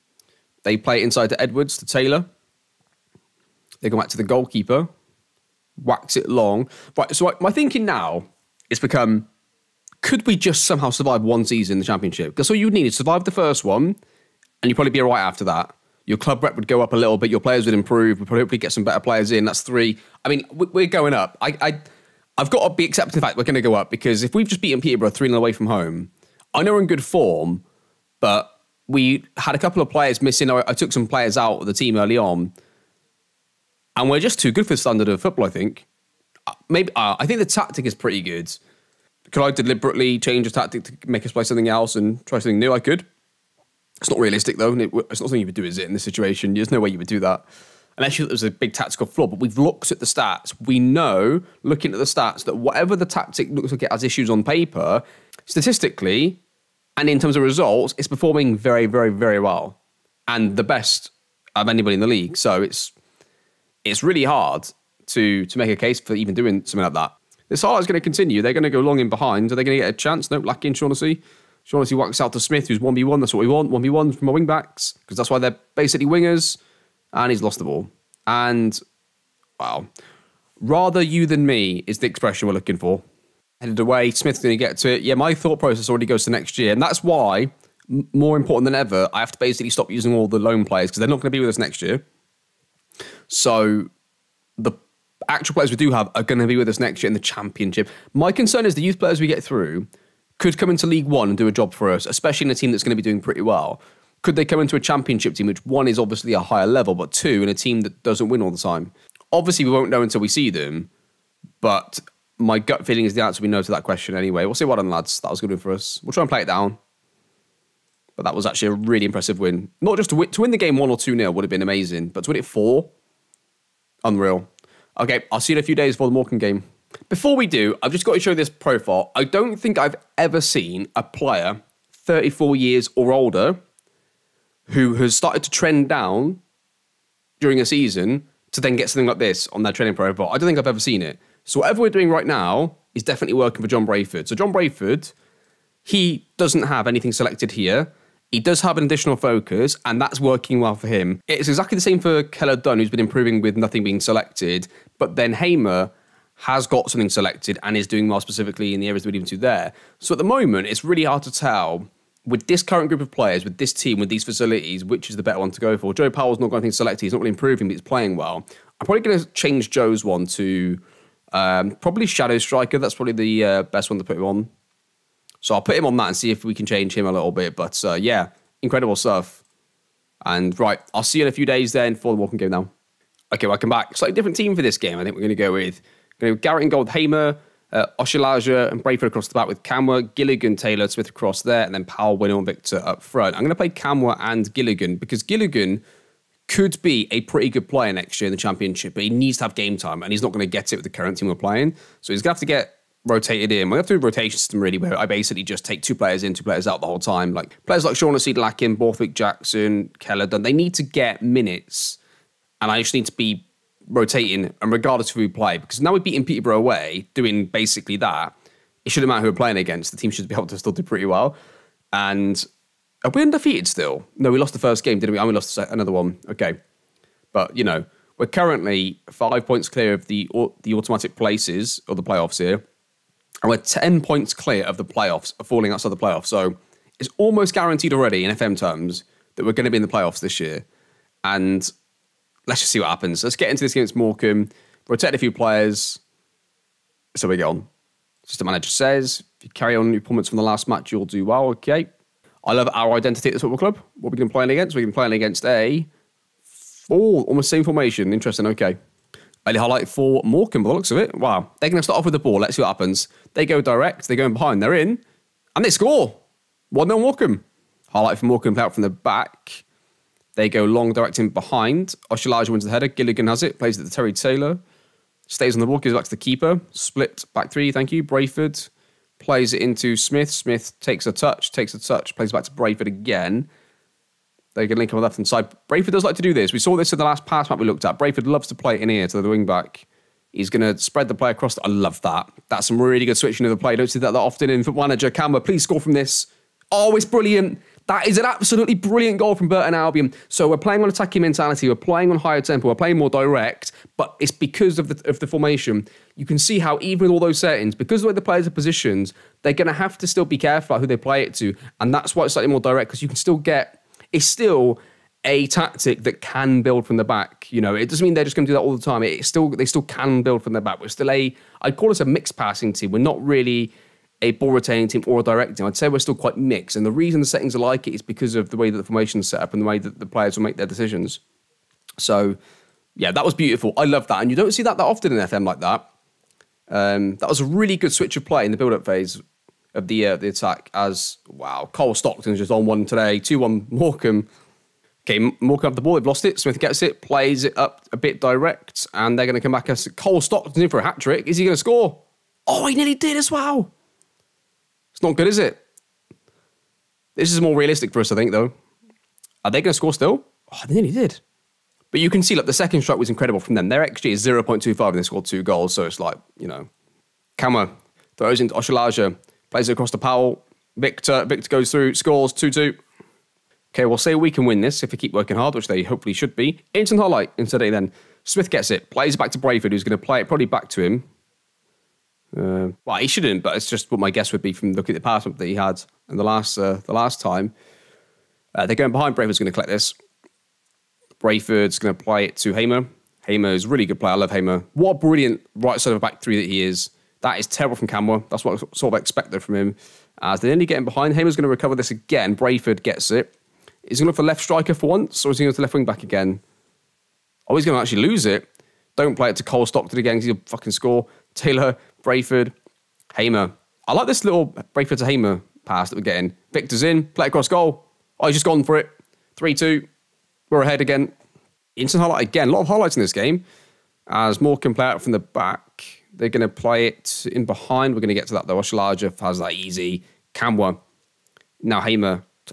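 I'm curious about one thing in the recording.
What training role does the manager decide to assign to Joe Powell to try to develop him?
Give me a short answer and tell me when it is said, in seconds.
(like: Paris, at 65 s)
Shadow Striker, at 172 s.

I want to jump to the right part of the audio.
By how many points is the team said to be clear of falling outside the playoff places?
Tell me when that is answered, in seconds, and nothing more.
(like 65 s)
233 s.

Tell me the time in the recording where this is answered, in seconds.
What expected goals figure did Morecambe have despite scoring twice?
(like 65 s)
364 s.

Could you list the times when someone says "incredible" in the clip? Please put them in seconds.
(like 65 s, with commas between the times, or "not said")
178 s, 363 s.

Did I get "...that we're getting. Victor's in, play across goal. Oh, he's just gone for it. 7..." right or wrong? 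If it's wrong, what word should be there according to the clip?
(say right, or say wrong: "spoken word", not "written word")
wrong: "3", not "7".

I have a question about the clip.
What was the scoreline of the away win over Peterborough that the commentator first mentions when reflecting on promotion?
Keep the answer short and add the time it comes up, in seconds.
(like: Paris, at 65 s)
3-0, at 25 s.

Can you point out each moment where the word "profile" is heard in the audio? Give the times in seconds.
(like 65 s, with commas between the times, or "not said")
128 s, 139 s.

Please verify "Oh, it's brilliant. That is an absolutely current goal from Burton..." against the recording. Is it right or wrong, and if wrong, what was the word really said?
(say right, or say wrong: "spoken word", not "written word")
wrong: "brilliant", not "current".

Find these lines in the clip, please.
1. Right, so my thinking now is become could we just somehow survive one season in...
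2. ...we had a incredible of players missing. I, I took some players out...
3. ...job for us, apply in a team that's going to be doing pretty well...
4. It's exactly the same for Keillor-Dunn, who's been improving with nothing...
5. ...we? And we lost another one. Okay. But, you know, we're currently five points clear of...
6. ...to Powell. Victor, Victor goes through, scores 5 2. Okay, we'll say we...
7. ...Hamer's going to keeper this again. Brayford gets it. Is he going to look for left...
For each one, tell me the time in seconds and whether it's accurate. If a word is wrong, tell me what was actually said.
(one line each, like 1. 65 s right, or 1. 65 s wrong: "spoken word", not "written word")
1. 6 s right
2. 28 s wrong: "couple", not "incredible"
3. 101 s wrong: "especially", not "apply"
4. 151 s right
5. 225 s right
6. 369 s wrong: "2", not "5"
7. 401 s wrong: "recover", not "keeper".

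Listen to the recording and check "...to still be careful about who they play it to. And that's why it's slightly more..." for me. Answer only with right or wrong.
right.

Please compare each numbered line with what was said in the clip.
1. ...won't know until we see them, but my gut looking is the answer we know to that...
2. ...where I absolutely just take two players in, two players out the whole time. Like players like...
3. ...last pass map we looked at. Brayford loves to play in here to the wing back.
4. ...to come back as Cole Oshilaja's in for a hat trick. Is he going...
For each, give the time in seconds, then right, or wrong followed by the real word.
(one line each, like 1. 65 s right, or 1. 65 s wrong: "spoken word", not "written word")
1. 109 s wrong: "feeling", not "looking"
2. 204 s wrong: "basically", not "absolutely"
3. 287 s right
4. 349 s wrong: "Stockton", not "Oshilaja".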